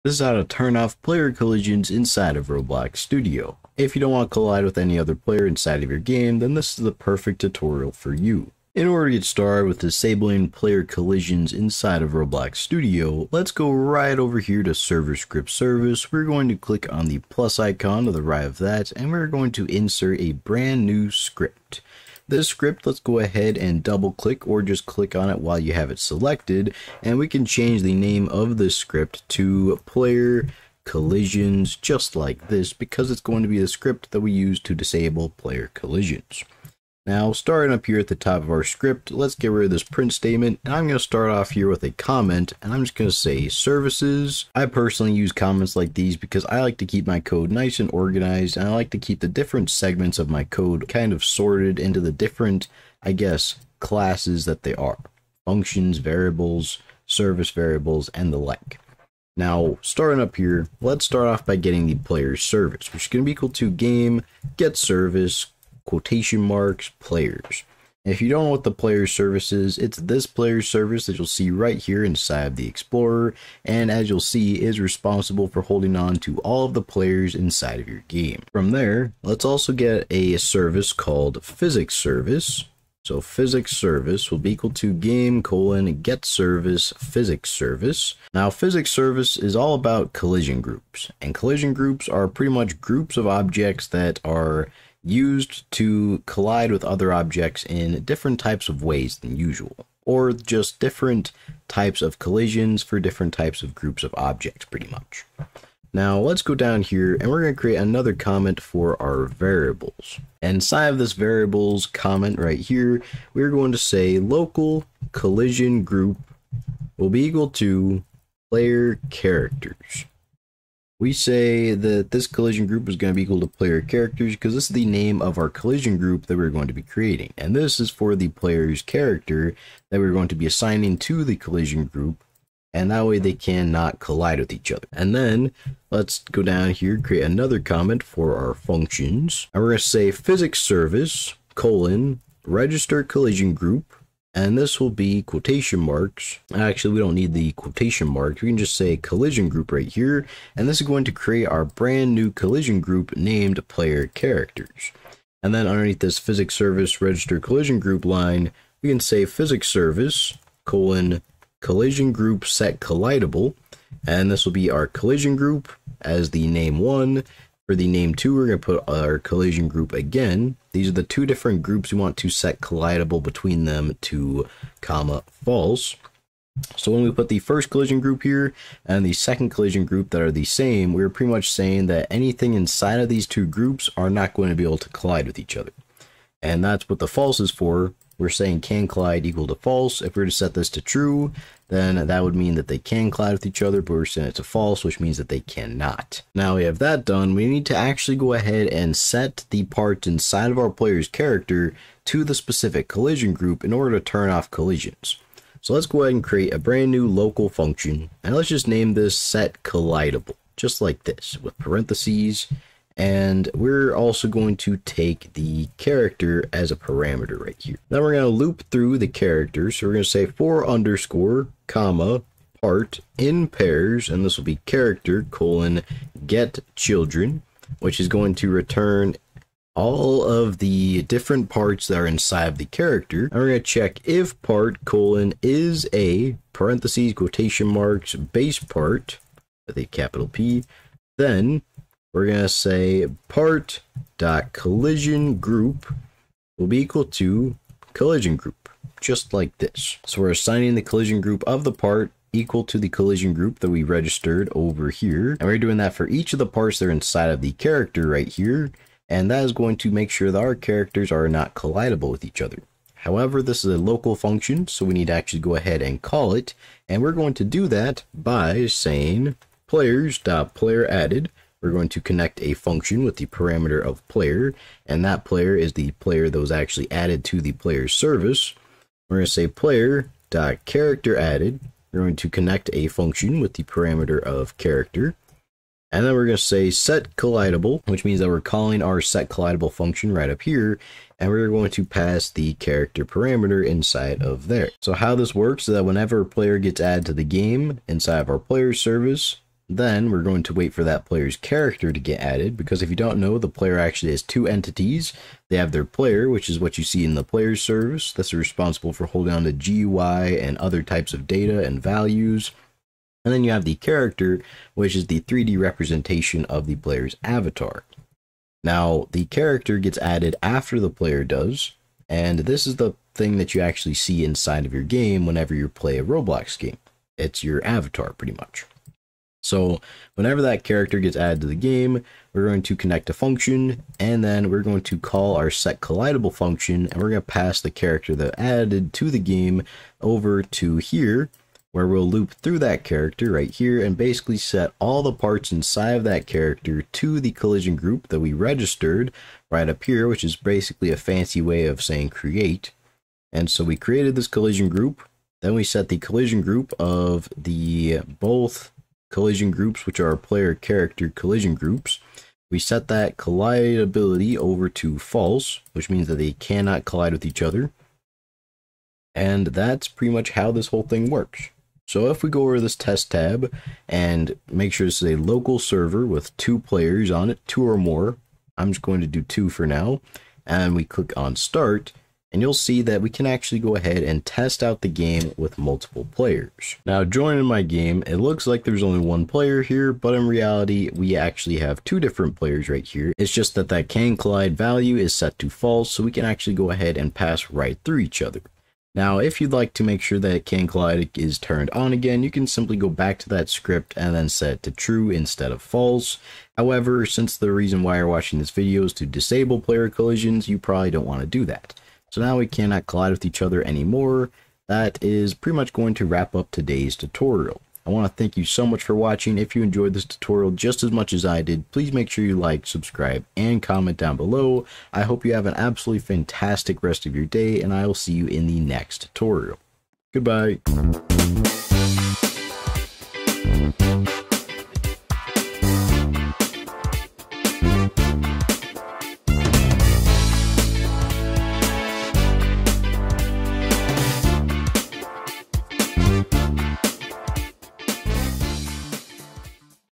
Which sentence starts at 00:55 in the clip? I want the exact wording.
Functions, variables, service variables, and the like.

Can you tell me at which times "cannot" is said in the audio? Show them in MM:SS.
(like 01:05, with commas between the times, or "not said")
02:13, 03:15, 06:06, 06:52.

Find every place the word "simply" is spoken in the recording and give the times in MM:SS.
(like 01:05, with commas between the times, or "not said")
06:42.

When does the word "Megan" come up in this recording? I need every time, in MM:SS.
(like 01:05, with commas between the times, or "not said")
not said.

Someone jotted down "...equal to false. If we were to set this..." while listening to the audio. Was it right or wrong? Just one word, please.
right.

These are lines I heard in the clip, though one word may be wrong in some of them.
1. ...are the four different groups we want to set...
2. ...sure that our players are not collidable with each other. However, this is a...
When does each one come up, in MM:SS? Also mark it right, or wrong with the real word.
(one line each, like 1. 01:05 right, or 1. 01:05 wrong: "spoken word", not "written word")
1. 02:50 wrong: "two", not "four"
2. 04:20 wrong: "characters", not "players".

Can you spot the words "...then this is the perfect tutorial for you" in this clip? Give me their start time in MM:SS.
00:06.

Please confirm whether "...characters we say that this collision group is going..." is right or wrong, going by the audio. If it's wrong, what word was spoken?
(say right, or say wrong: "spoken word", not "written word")
right.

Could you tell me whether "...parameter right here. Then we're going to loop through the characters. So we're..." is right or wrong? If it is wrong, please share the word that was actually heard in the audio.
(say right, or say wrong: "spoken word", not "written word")
right.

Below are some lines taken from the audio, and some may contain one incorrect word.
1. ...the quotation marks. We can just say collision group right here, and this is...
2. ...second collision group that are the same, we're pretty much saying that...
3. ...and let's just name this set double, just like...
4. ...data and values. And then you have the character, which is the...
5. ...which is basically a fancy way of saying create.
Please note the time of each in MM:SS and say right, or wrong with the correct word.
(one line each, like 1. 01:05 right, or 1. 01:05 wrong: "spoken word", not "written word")
1. 02:27 right
2. 02:59 right
3. 03:28 wrong: "collidable", not "double"
4. 05:11 right
5. 05:50 right.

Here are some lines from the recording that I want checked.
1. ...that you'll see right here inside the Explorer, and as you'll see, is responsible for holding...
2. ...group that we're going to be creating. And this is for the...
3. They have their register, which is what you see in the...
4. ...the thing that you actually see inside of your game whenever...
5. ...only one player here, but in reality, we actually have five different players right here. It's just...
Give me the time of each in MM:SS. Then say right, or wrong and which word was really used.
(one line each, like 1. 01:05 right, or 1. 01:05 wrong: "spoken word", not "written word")
1. 01:11 right
2. 02:05 right
3. 05:05 wrong: "player", not "register"
4. 05:22 right
5. 06:28 wrong: "two", not "five".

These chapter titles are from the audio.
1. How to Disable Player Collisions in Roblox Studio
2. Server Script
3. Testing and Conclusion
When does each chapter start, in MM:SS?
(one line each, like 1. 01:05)
1. 00:12
2. 00:40
3. 06:26.